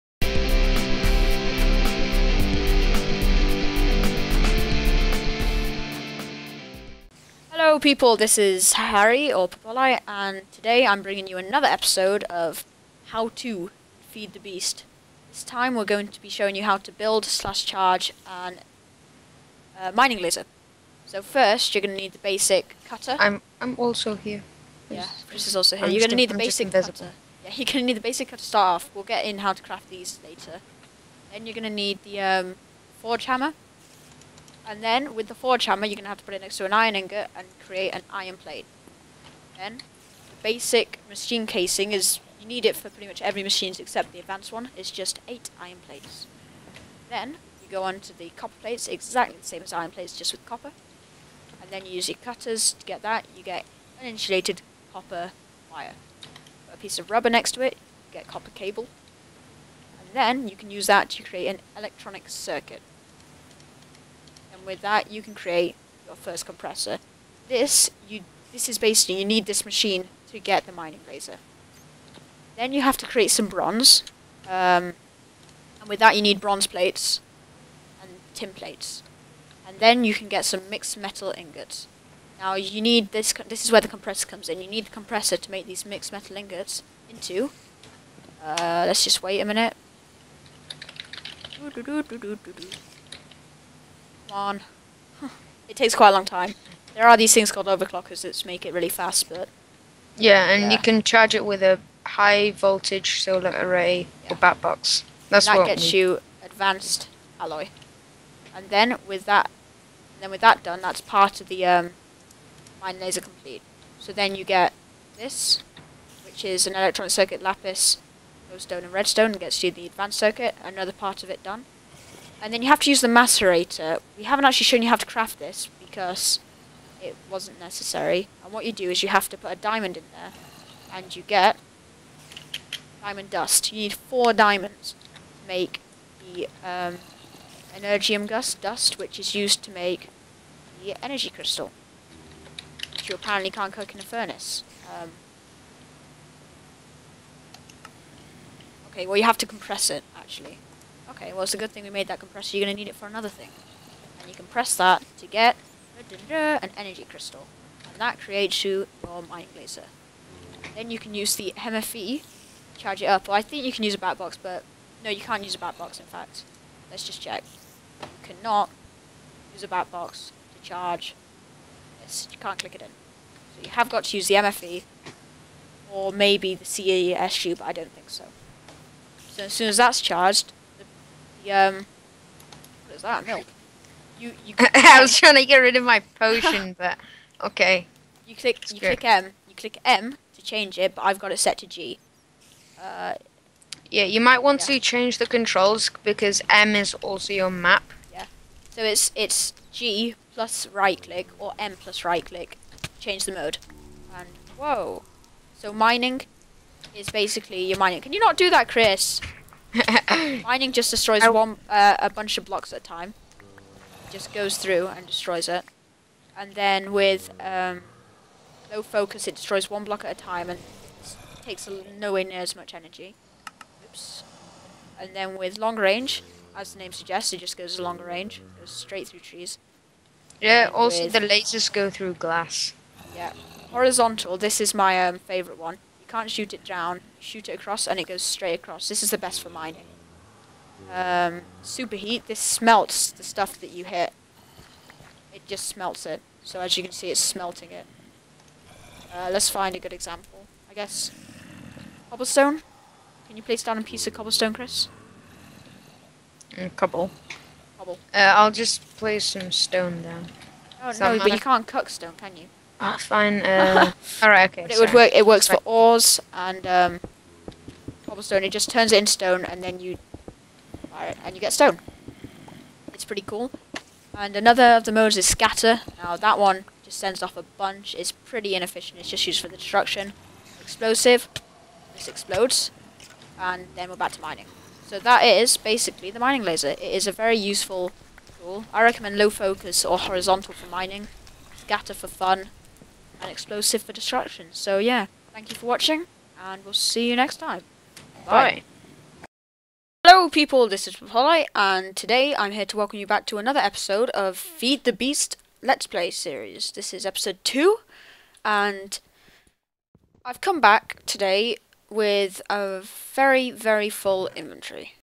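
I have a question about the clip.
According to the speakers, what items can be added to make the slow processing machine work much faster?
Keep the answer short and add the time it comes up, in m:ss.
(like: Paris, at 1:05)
Overclockers, at 1:37.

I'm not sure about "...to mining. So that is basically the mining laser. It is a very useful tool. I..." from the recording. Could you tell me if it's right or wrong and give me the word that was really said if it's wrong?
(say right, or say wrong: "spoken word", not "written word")
right.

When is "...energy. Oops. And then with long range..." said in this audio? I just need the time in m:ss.
3:42.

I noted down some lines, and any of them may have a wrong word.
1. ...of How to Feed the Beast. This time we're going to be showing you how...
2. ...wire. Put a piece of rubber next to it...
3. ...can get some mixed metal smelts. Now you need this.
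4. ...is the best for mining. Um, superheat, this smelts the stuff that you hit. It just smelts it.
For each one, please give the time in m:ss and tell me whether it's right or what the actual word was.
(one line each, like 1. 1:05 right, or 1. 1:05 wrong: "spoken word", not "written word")
1. 0:12 right
2. 0:55 right
3. 1:20 wrong: "ingots", not "smelts"
4. 3:59 right.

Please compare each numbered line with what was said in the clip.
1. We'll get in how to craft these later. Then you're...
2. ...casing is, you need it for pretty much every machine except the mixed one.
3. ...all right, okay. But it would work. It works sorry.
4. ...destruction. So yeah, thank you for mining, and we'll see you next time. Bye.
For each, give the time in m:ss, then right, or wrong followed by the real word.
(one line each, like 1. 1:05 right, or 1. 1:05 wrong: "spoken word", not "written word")
1. 0:28 right
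2. 0:41 wrong: "advanced", not "mixed"
3. 4:24 right
4. 4:53 wrong: "watching", not "mining".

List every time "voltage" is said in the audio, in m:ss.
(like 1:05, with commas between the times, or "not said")
1:42.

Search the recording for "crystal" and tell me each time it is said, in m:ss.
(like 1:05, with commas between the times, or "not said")
2:21, 2:37.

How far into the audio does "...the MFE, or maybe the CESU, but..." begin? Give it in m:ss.
2:54.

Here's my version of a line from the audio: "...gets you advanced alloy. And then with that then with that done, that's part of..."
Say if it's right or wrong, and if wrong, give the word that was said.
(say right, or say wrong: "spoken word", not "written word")
right.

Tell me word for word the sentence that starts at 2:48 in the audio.
You cannot use a bat box to charge.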